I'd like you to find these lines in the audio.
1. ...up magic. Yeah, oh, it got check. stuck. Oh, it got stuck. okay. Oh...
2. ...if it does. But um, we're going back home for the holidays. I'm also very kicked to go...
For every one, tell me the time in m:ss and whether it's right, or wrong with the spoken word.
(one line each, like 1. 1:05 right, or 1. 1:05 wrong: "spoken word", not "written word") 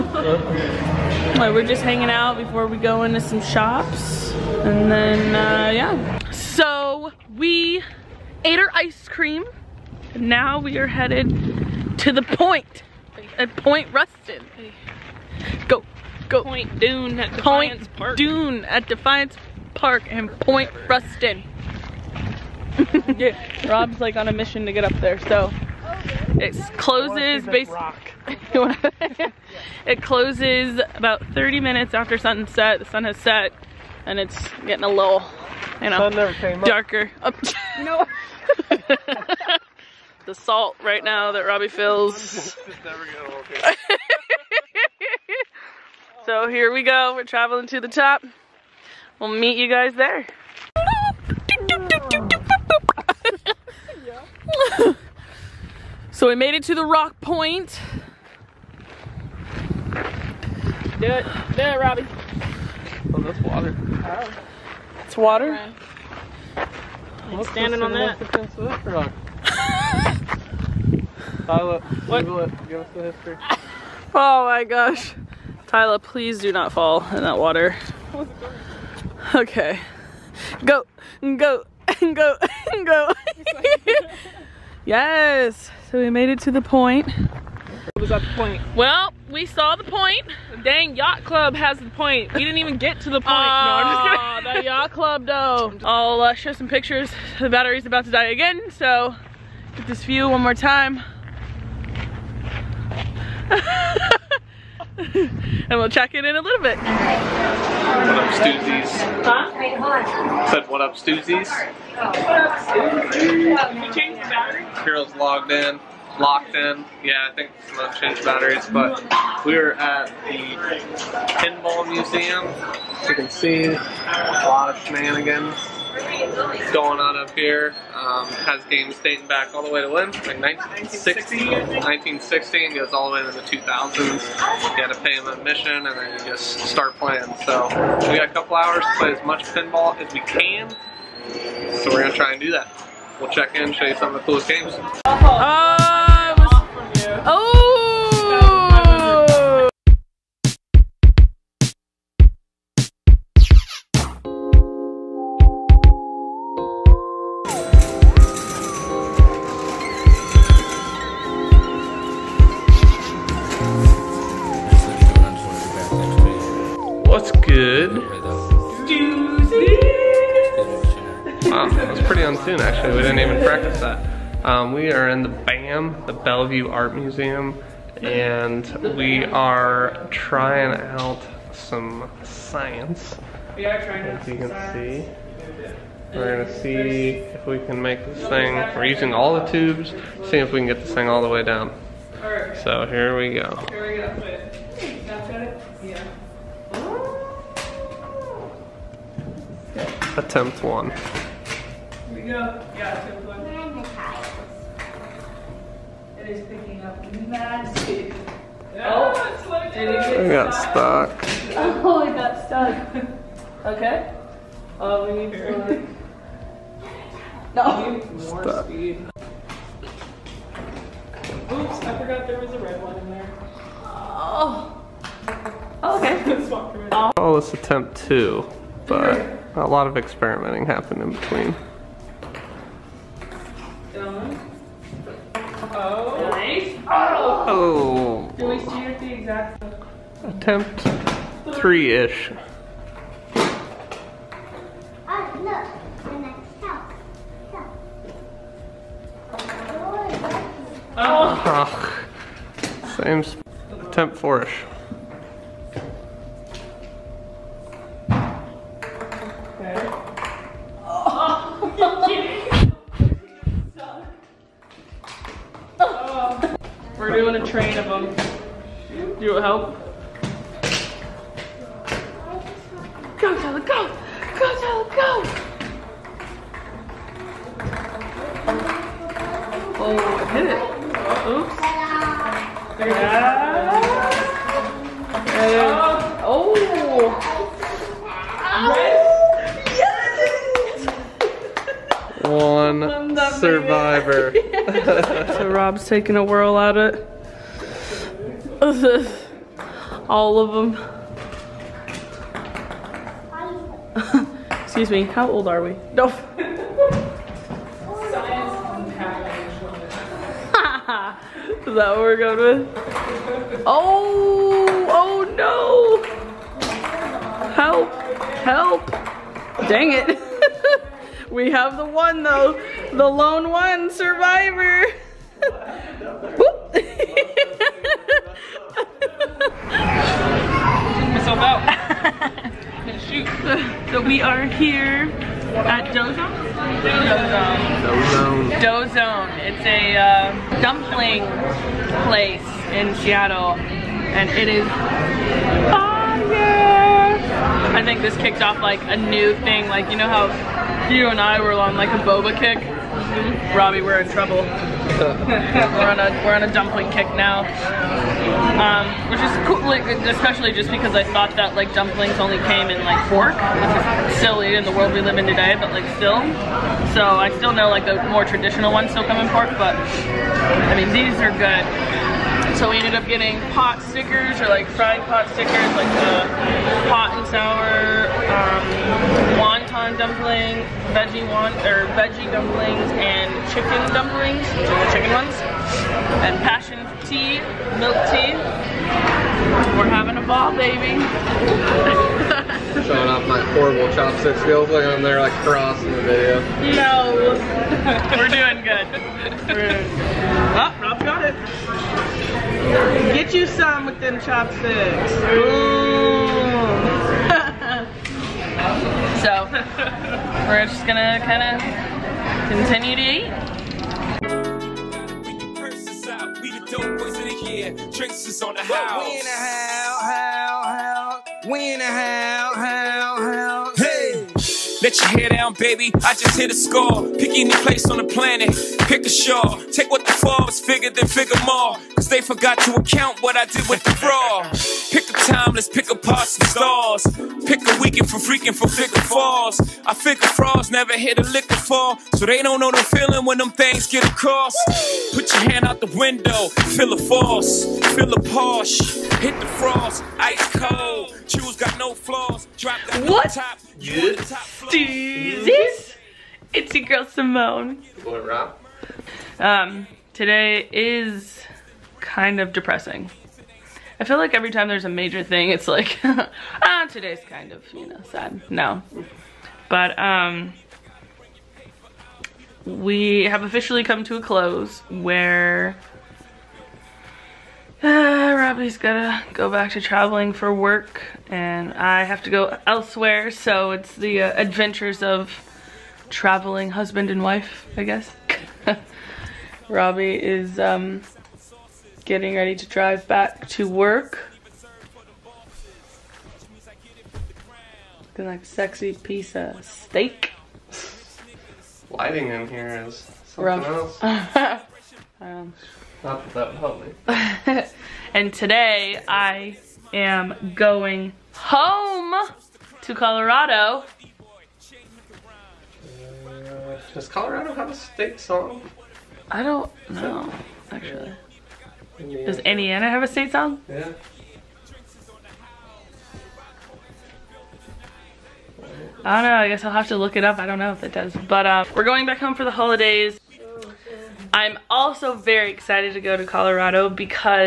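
1. 3:26 wrong: "stuck", not "check"
2. 8:50 wrong: "excited", not "kicked".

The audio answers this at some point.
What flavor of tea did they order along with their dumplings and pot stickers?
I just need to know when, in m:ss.
6:26.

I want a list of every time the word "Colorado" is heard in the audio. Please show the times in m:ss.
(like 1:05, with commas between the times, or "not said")
8:32, 8:37, 8:56.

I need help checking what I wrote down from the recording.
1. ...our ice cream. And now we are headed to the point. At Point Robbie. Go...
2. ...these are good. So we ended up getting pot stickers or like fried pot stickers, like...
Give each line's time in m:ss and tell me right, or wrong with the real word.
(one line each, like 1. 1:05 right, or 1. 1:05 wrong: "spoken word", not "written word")
1. 0:08 wrong: "Ruston", not "Robbie"
2. 6:10 right.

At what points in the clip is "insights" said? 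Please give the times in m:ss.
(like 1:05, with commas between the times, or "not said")
not said.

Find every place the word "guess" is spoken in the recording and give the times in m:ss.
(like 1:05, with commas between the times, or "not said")
8:07, 8:49.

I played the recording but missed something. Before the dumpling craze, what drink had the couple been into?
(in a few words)
Boba.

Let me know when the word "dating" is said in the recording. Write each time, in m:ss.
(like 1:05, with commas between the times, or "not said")
2:09.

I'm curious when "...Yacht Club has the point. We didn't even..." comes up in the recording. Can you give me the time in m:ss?
1:30.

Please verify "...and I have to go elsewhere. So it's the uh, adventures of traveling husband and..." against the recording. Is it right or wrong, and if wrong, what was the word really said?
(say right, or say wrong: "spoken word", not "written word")
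right.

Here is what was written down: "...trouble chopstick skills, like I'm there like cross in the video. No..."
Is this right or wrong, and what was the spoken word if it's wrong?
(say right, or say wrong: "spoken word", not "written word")
wrong: "horrible", not "trouble".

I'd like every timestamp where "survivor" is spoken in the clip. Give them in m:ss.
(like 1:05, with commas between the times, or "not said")
4:53, 5:23.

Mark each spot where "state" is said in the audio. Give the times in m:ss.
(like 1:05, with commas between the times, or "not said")
8:37, 8:43.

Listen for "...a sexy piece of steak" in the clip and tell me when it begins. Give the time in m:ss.
8:18.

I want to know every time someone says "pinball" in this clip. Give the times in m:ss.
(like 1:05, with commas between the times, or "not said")
2:01, 2:19.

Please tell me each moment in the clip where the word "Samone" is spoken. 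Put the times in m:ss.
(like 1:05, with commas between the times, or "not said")
1:57, 7:37.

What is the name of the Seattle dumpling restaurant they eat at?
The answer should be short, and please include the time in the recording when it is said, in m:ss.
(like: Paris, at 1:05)
Dough Zone, at 5:38.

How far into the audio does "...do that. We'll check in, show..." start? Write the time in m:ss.
2:22.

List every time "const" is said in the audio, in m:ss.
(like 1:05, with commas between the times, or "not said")
not said.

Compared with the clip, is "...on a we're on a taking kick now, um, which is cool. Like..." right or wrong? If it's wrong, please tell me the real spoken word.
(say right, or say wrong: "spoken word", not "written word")
wrong: "dumpling", not "taking".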